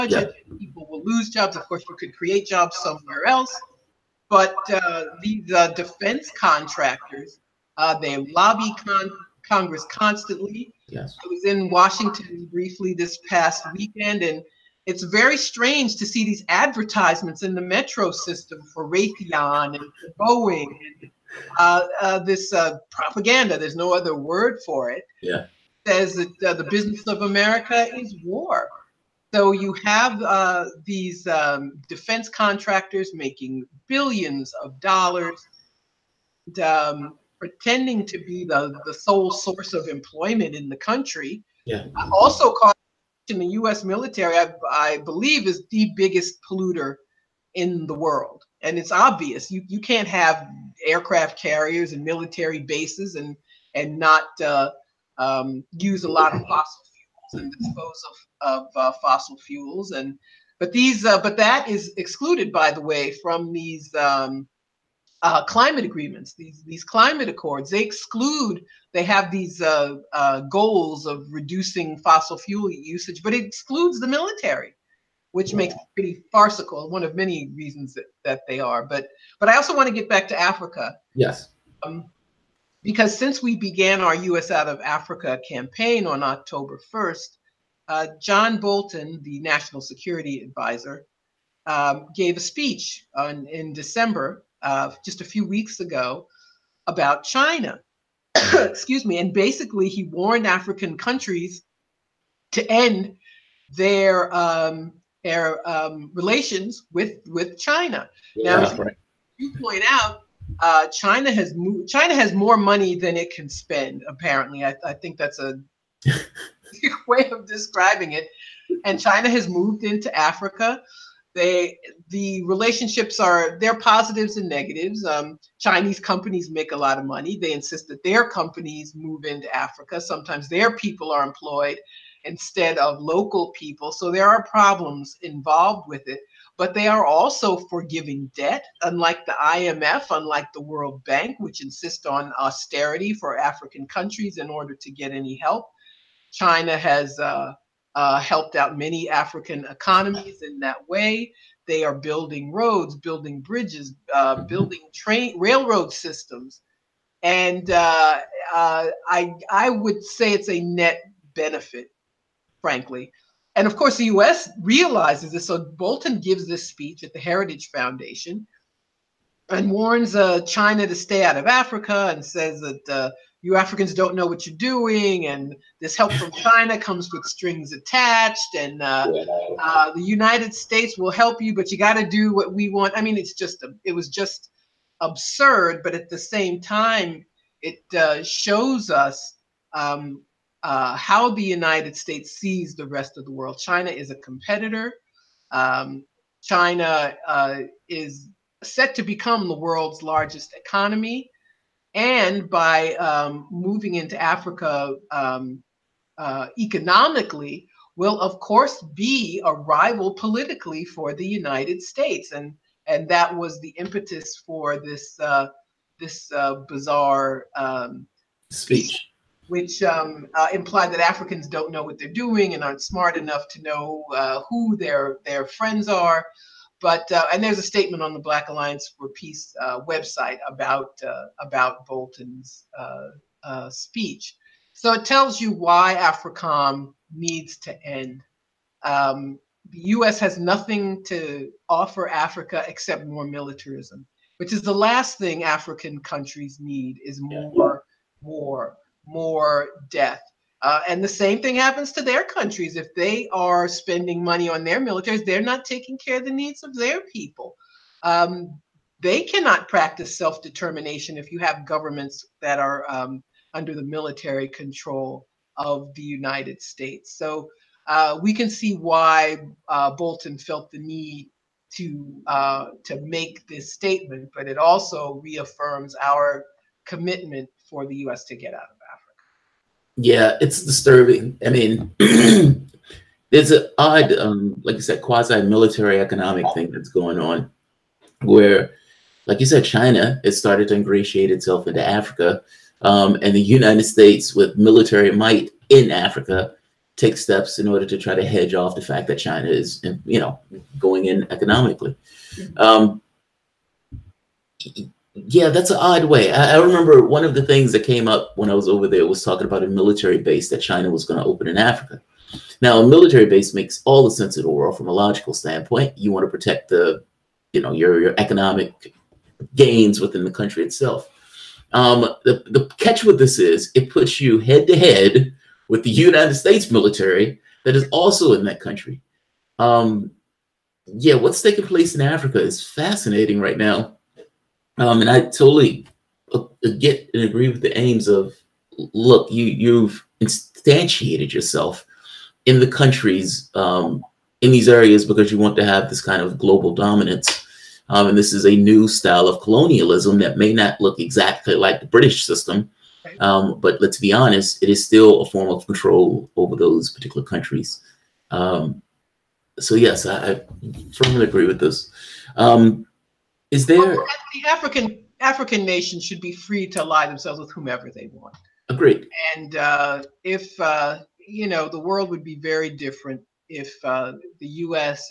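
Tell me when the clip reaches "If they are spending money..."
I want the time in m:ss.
4:12.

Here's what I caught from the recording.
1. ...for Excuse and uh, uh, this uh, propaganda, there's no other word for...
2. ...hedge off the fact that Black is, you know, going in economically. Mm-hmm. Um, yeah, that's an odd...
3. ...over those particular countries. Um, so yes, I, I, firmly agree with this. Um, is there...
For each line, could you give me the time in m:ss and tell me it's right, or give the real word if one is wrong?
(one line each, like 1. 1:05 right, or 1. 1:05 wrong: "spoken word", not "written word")
1. 0:20 wrong: "Boeing", not "Excuse"
2. 4:58 wrong: "China", not "Black"
3. 5:56 right.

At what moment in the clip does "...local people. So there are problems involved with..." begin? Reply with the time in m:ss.
2:12.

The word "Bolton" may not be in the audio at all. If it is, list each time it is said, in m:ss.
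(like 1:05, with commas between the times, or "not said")
1:28, 2:45, 3:51, 4:29.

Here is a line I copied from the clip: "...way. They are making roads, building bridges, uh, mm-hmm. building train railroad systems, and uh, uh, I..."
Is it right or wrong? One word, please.
wrong.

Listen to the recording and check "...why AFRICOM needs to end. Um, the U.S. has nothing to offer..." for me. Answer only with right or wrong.
right.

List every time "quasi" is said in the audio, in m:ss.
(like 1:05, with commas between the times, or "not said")
4:45.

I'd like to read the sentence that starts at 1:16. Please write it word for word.
One of many reasons that, that they are.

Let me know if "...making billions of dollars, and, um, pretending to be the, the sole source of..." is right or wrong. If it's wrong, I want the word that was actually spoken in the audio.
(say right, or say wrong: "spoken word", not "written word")
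right.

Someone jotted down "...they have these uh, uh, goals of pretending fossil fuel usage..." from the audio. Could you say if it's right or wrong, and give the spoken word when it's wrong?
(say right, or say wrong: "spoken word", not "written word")
wrong: "reducing", not "pretending".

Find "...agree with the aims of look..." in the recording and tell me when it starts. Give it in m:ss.
5:37.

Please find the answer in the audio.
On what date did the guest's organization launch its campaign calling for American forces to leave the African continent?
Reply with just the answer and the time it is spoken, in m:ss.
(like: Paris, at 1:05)
October 1, at 1:26.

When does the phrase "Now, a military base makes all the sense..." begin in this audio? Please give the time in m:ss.
5:12.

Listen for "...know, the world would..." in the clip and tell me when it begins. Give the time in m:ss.
6:11.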